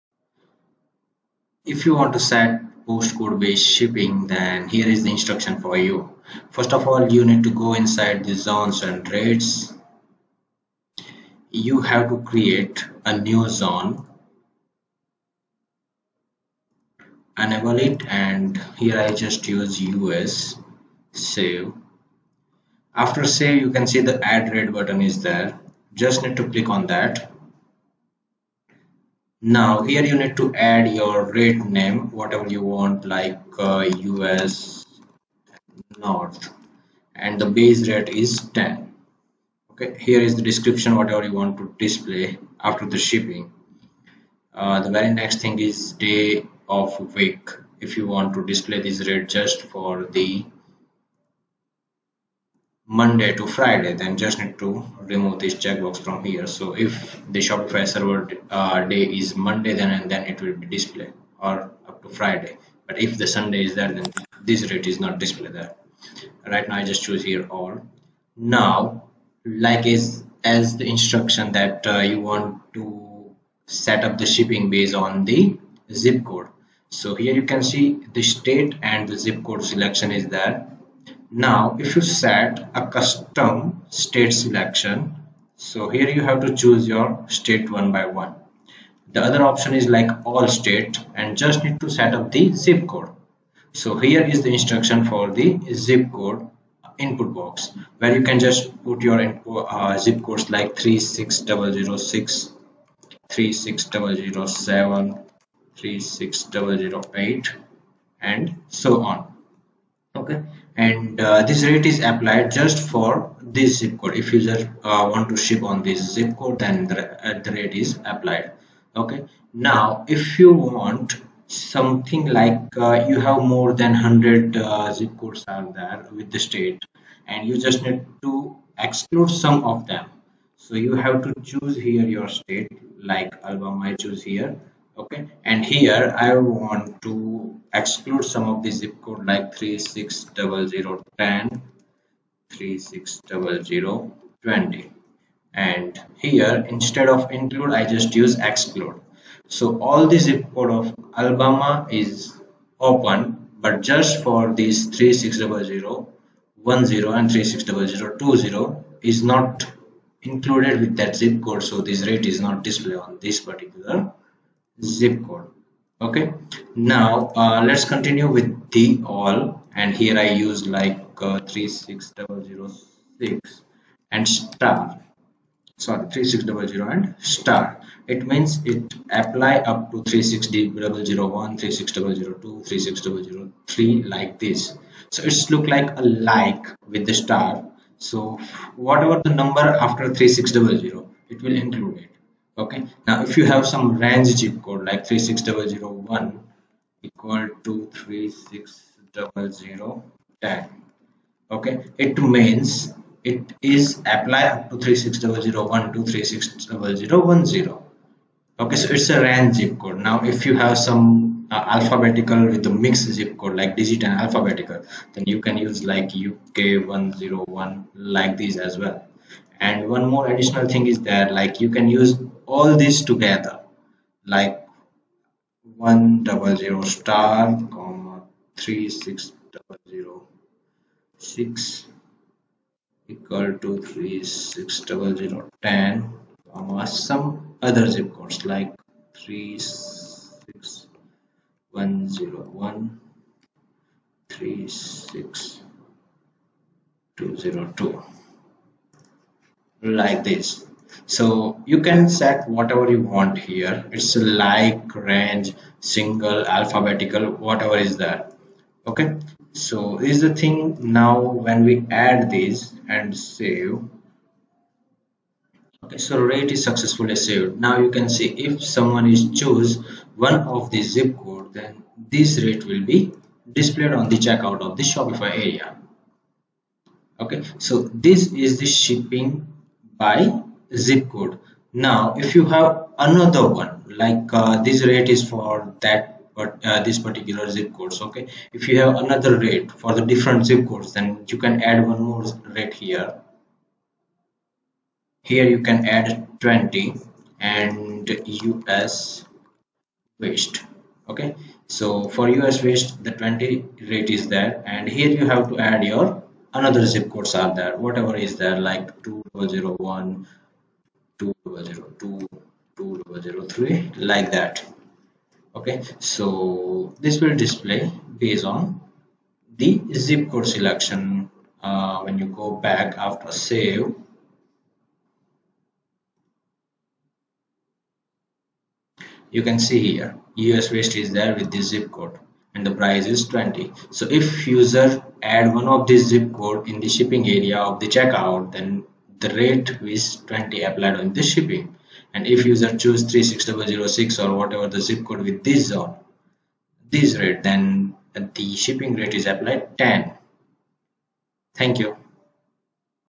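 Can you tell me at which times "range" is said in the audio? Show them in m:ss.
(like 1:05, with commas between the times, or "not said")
3:13, 3:29, 4:14.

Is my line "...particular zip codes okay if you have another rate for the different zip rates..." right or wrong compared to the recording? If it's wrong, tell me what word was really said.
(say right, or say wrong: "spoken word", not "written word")
wrong: "codes", not "rates".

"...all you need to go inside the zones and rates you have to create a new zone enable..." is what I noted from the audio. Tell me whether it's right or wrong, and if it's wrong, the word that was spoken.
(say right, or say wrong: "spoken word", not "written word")
right.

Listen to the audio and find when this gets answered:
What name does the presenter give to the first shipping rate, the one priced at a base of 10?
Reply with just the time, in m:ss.
0:33.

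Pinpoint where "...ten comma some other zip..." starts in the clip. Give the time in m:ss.
3:55.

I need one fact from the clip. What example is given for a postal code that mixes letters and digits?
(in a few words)
uk101.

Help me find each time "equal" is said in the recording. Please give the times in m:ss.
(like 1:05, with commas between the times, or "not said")
3:17, 3:53.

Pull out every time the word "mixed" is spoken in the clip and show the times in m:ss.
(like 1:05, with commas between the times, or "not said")
3:32.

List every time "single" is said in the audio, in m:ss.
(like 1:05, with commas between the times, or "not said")
4:15.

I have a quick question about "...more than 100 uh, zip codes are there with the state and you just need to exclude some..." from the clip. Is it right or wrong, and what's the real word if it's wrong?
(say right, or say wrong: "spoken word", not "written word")
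right.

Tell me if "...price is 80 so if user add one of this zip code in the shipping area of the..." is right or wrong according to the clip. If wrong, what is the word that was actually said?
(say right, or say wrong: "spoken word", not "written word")
wrong: "20", not "80".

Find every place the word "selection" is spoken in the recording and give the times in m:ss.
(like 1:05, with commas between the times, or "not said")
1:19, 1:24, 5:20.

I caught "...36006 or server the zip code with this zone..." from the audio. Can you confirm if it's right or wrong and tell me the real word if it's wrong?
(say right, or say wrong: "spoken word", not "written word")
wrong: "whatever", not "server".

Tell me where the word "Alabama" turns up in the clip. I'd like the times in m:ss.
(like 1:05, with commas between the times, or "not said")
2:13, 2:31.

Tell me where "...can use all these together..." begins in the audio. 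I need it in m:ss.
3:41.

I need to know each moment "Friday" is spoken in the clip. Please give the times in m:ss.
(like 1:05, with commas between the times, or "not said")
0:53, 1:02.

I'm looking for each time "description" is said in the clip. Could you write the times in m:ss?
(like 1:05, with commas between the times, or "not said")
0:40.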